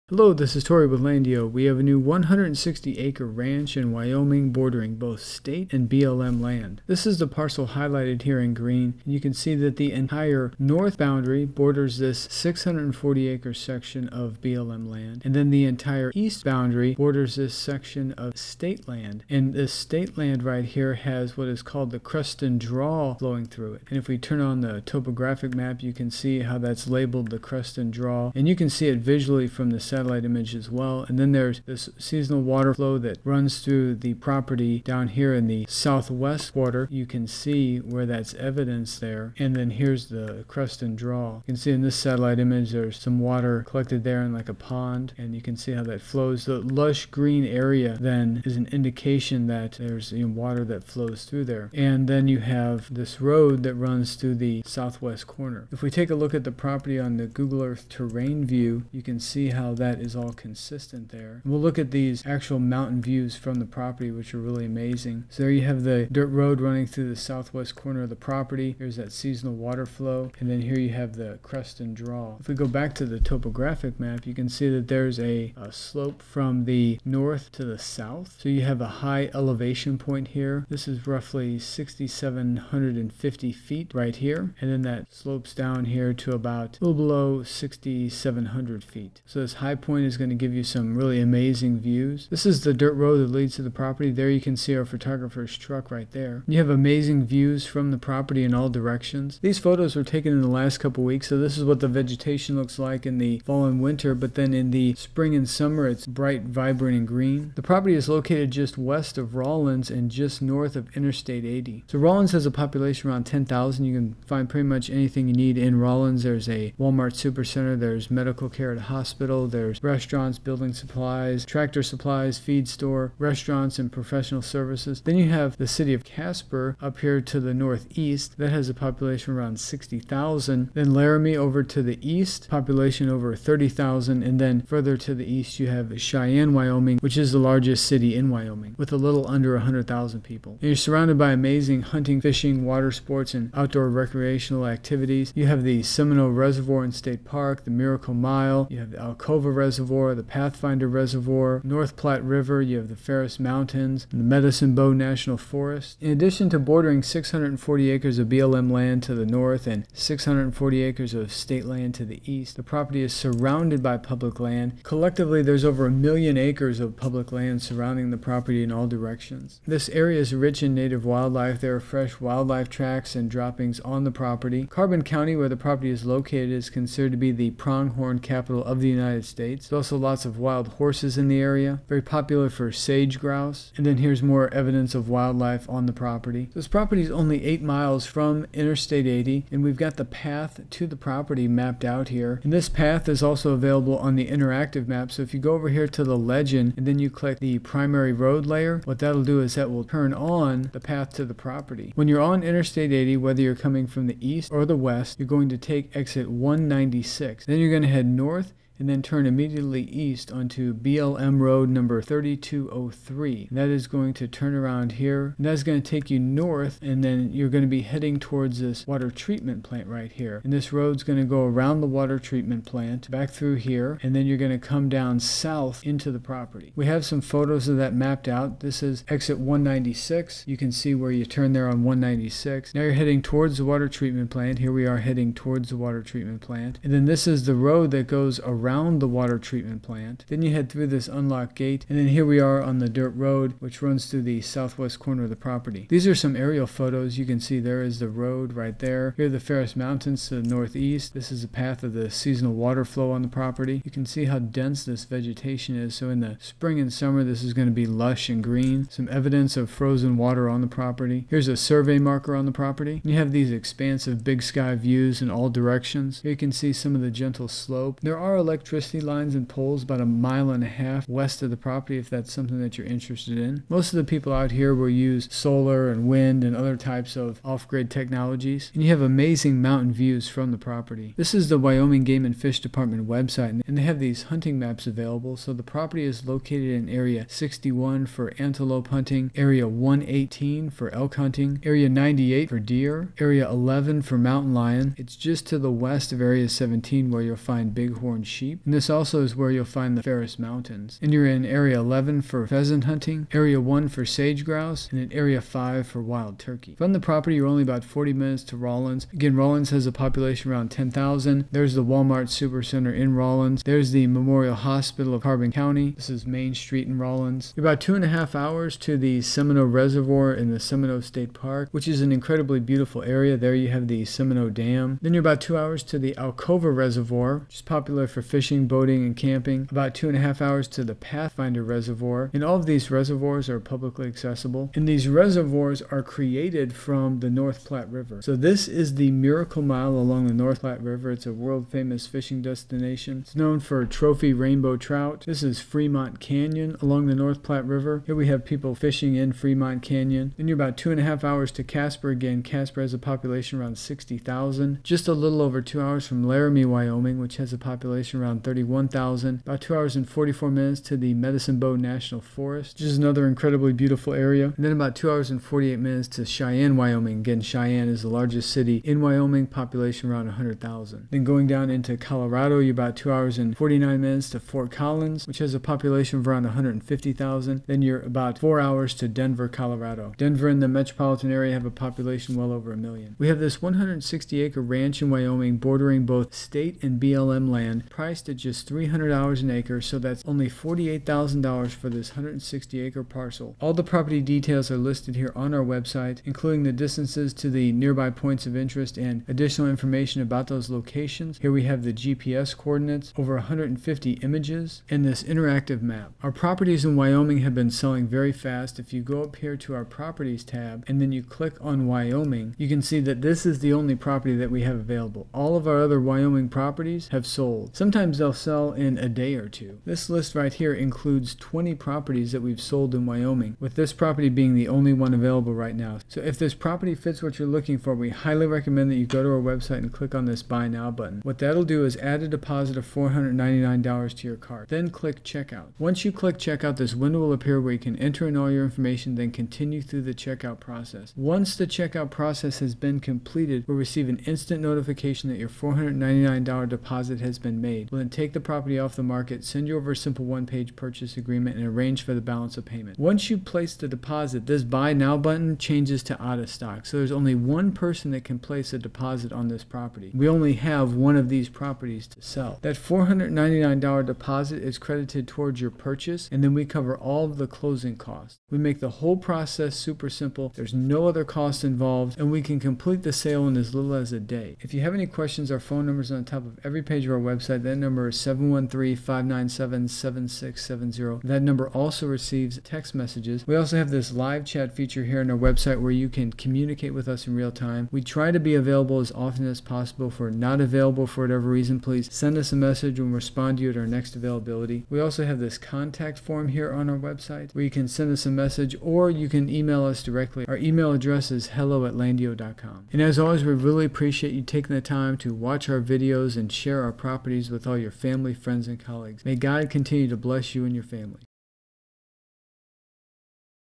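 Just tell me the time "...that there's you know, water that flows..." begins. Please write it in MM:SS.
00:49.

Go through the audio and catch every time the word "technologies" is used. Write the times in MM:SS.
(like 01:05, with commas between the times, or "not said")
04:37.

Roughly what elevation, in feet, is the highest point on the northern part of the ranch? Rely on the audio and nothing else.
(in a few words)
6,750 feet.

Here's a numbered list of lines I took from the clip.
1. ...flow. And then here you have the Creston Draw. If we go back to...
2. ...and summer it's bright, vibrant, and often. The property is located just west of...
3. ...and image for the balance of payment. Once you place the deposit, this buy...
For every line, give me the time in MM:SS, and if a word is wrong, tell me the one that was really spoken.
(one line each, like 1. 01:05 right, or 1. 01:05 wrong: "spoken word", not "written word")
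1. 01:09 right
2. 01:45 wrong: "green", not "often"
3. 07:31 wrong: "arrange", not "image".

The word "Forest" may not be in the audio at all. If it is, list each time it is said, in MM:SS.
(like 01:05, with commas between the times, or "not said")
02:35, 06:02.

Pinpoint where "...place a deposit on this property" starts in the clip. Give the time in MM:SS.
07:38.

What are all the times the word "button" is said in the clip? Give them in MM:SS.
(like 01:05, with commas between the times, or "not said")
07:10, 07:35.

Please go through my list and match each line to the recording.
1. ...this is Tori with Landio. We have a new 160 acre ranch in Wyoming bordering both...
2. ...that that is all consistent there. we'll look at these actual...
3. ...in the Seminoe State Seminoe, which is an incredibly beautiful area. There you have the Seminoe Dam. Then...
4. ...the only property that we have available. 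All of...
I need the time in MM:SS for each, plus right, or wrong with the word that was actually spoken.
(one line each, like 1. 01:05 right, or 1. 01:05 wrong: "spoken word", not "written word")
1. 00:00 right
2. 00:59 right
3. 05:20 wrong: "Park", not "Seminoe"
4. 06:53 right.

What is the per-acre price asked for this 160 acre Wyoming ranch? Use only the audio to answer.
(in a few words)
$300.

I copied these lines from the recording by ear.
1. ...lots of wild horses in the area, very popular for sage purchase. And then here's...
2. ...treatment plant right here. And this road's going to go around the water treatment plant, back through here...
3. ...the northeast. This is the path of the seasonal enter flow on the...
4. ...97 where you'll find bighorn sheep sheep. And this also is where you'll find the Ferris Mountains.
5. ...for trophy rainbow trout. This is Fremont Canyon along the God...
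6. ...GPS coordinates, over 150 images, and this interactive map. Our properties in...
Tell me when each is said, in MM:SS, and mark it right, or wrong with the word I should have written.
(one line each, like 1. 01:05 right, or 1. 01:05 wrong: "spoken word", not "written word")
1. 02:59 wrong: "grouse", not "purchase"
2. 03:39 right
3. 04:10 wrong: "water", not "enter"
4. 04:56 wrong: "17", not "97"
5. 05:43 wrong: "North", not "God"
6. 06:41 right.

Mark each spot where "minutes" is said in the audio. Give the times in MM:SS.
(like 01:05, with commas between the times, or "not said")
05:08, 06:00, 06:05, 06:14.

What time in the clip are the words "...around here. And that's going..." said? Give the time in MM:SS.
03:34.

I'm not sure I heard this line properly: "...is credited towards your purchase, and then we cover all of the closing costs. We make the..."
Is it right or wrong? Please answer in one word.
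right.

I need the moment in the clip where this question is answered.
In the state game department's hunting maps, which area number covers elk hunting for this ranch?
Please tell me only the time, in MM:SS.
04:49.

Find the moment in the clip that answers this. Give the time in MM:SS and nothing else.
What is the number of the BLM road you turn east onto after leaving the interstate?
03:31.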